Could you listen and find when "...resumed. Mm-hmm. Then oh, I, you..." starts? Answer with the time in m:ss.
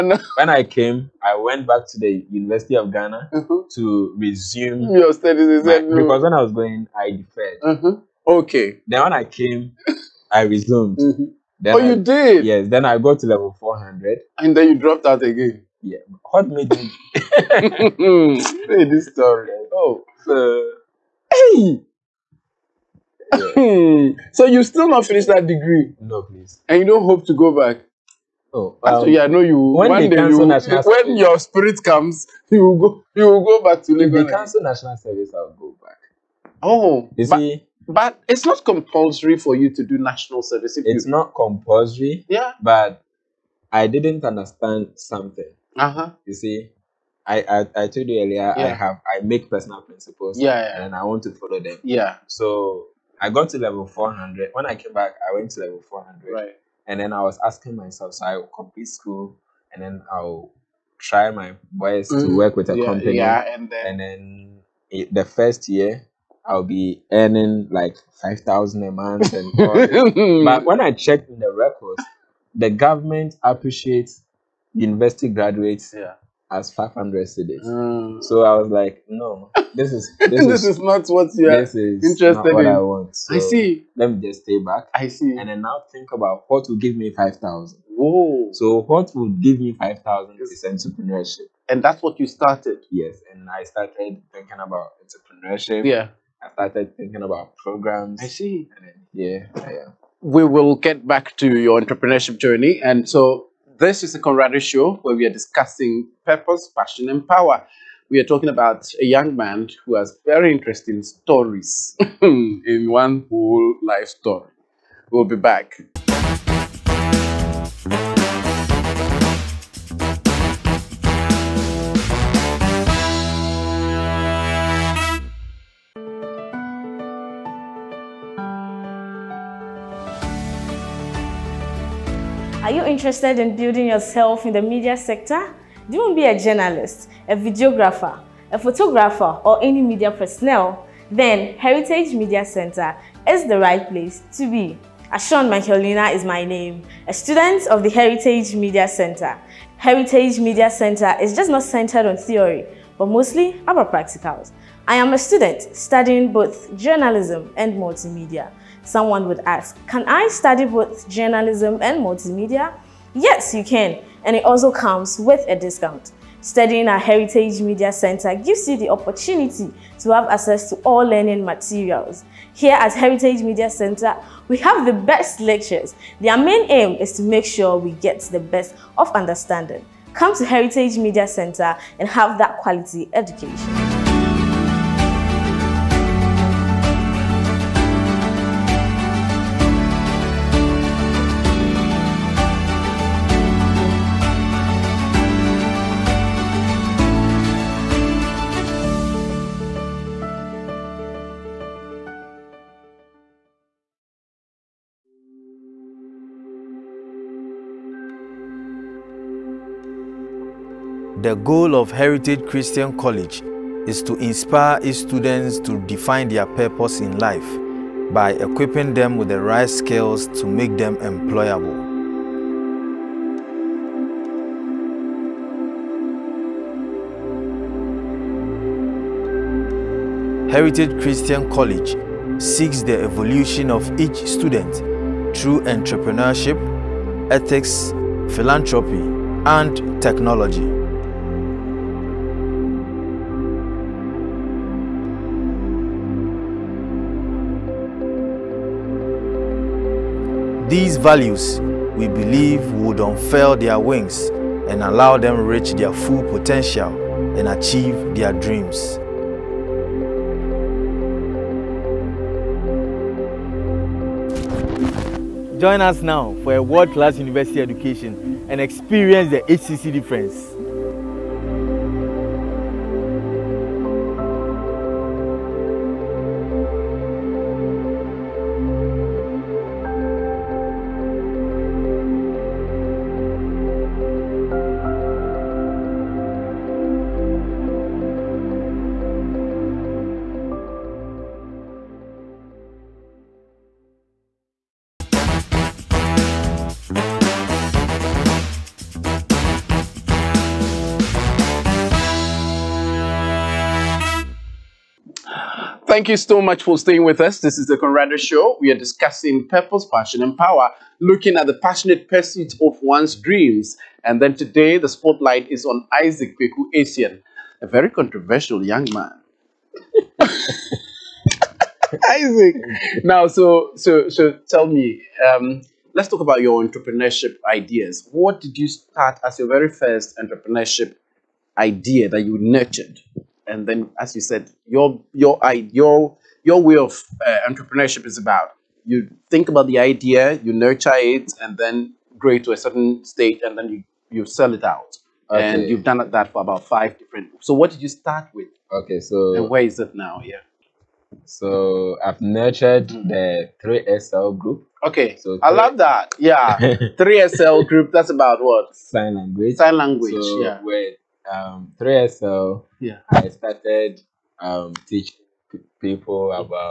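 0:10.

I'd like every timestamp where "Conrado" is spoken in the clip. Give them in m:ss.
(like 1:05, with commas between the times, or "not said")
1:44, 5:07.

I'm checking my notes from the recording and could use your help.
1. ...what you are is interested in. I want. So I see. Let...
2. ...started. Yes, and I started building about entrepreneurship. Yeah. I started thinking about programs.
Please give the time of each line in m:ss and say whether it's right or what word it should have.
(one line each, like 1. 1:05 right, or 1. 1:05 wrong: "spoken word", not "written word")
1. 1:21 right
2. 1:32 wrong: "thinking", not "building".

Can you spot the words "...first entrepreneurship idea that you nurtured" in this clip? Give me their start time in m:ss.
5:29.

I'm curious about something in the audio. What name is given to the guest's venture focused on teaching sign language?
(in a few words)
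3SL group.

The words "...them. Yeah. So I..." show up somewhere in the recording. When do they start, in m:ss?
0:51.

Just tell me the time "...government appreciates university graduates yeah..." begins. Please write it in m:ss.
1:12.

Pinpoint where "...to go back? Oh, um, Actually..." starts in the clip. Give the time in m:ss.
0:27.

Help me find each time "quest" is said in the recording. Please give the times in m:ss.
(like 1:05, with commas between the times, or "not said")
not said.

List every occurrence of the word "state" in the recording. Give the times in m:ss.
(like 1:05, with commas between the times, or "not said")
5:43.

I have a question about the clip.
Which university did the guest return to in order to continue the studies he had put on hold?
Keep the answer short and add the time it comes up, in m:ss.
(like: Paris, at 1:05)
University of Ghana, at 0:02.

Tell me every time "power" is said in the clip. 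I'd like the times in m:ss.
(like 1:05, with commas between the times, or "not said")
1:47, 5:10.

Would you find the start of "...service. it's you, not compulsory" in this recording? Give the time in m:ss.
0:40.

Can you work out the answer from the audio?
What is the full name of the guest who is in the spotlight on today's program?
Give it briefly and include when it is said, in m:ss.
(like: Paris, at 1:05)
Isaac Kwaku Essien, at 5:16.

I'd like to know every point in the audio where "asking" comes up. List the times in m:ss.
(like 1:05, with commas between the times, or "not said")
0:57.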